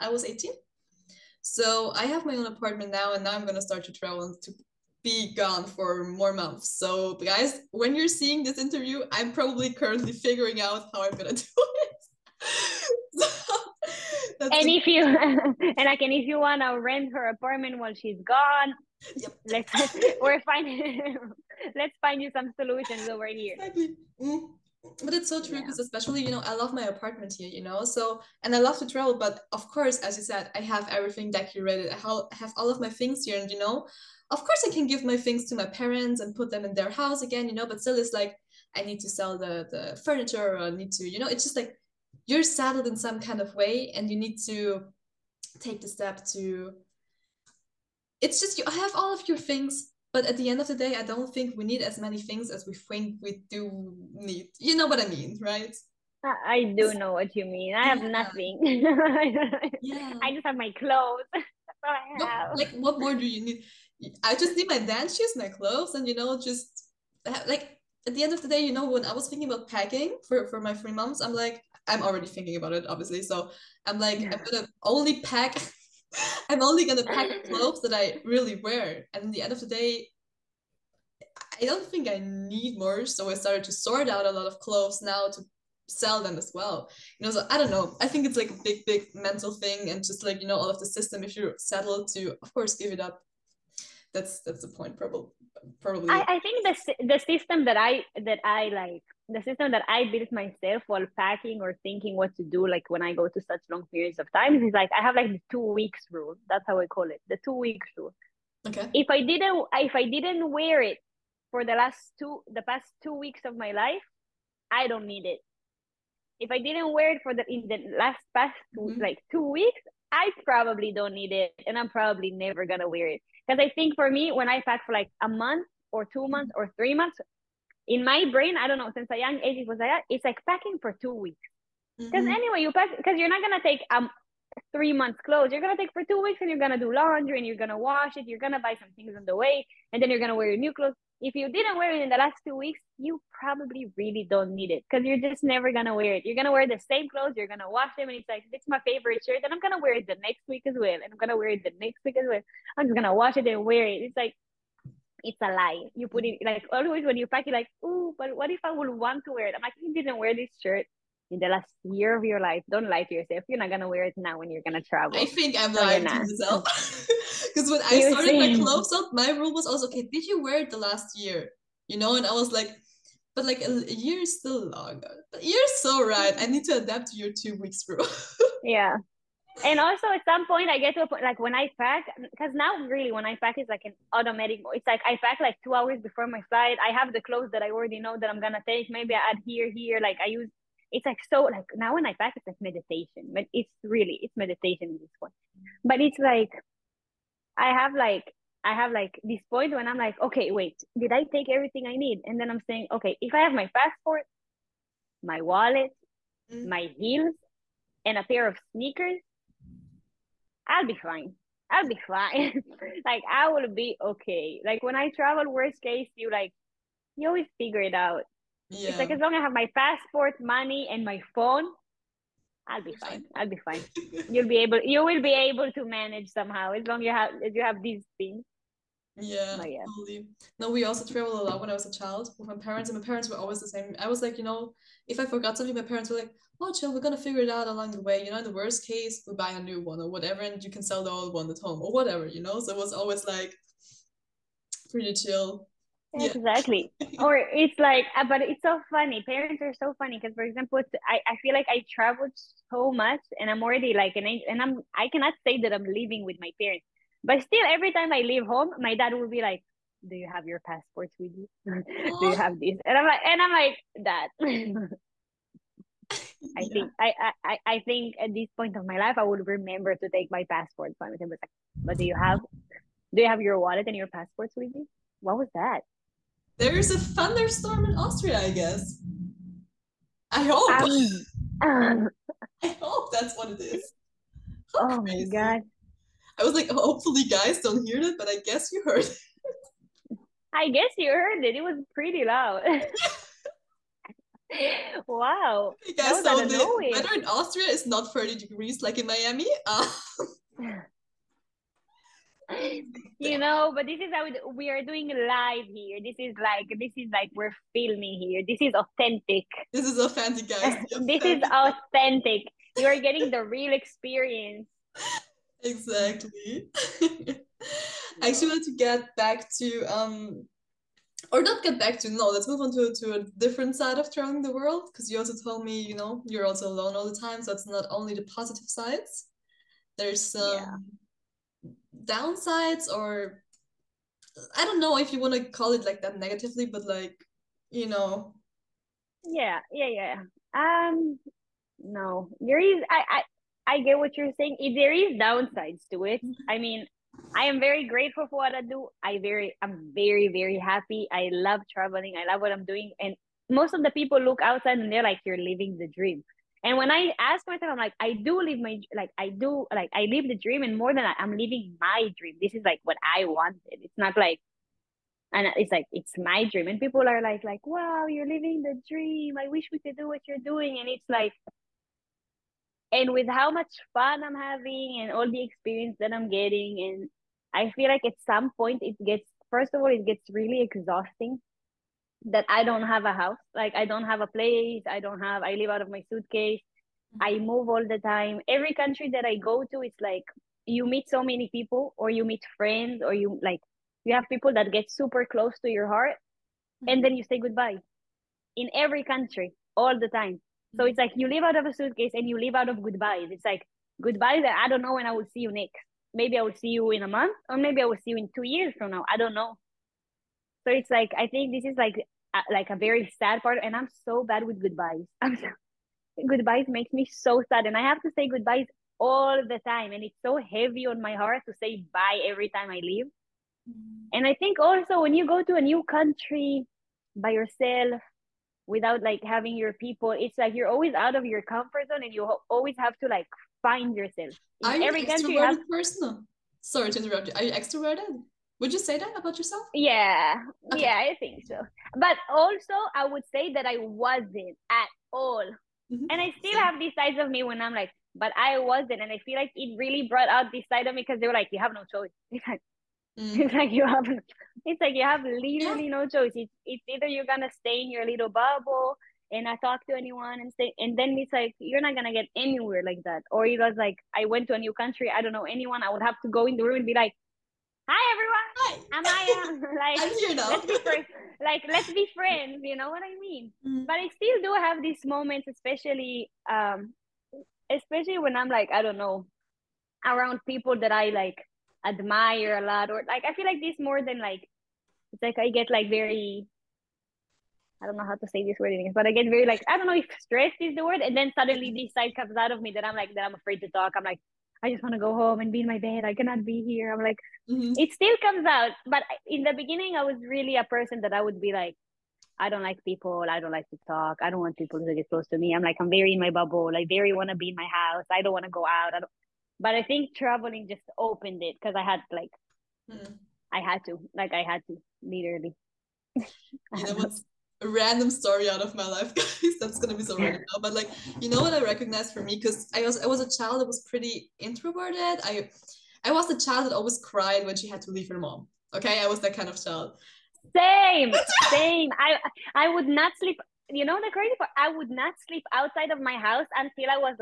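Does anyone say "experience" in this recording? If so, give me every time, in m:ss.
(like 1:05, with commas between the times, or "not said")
5:13, 6:15.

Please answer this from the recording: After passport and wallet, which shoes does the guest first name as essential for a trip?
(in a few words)
Heels.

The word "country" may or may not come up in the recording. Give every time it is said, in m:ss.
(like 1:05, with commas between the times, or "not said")
6:28, 6:39, 7:05, 7:15, 7:44.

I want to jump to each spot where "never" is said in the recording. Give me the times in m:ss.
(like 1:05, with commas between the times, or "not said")
2:02, 2:25.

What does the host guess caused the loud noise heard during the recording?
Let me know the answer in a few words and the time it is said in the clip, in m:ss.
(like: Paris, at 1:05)
A thunderstorm, at 4:36.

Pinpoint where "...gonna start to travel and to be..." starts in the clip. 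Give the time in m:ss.
0:03.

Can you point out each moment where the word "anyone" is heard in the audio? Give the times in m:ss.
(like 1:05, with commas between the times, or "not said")
7:39, 7:45.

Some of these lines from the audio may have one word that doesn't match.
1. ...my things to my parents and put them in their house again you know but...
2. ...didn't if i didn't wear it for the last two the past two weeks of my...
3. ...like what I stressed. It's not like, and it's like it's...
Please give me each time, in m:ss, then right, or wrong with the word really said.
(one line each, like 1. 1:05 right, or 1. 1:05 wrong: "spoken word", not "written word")
1. 0:35 right
2. 1:49 right
3. 6:02 wrong: "wanted", not "stressed".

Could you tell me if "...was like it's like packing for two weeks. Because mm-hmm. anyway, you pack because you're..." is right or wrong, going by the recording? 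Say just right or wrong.
right.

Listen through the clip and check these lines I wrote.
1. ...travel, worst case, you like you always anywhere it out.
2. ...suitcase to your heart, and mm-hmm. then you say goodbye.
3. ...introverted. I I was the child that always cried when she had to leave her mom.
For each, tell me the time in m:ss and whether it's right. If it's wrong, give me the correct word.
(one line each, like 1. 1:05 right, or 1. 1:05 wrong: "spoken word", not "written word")
1. 3:35 wrong: "figure", not "anywhere"
2. 6:35 wrong: "close", not "suitcase"
3. 8:44 right.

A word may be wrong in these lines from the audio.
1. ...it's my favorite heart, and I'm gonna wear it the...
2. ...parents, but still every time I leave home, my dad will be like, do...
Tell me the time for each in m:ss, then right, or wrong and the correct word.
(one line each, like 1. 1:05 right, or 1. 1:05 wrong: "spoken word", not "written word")
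1. 2:28 wrong: "shirt", not "heart"
2. 4:16 right.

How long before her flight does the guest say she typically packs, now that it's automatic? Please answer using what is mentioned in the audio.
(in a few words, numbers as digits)
Two hours.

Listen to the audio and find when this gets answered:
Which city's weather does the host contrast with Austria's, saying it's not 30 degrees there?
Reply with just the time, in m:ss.
4:59.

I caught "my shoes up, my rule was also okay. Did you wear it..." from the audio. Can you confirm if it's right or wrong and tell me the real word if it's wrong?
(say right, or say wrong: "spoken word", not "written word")
wrong: "clothes", not "shoes".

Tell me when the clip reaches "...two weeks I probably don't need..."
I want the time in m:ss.
1:59.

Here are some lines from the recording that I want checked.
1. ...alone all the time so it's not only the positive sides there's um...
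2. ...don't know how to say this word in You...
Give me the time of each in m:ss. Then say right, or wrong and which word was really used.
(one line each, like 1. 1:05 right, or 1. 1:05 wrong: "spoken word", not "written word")
1. 5:26 right
2. 8:07 wrong: "English", not "You".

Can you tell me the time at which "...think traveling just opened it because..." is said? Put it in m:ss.
8:29.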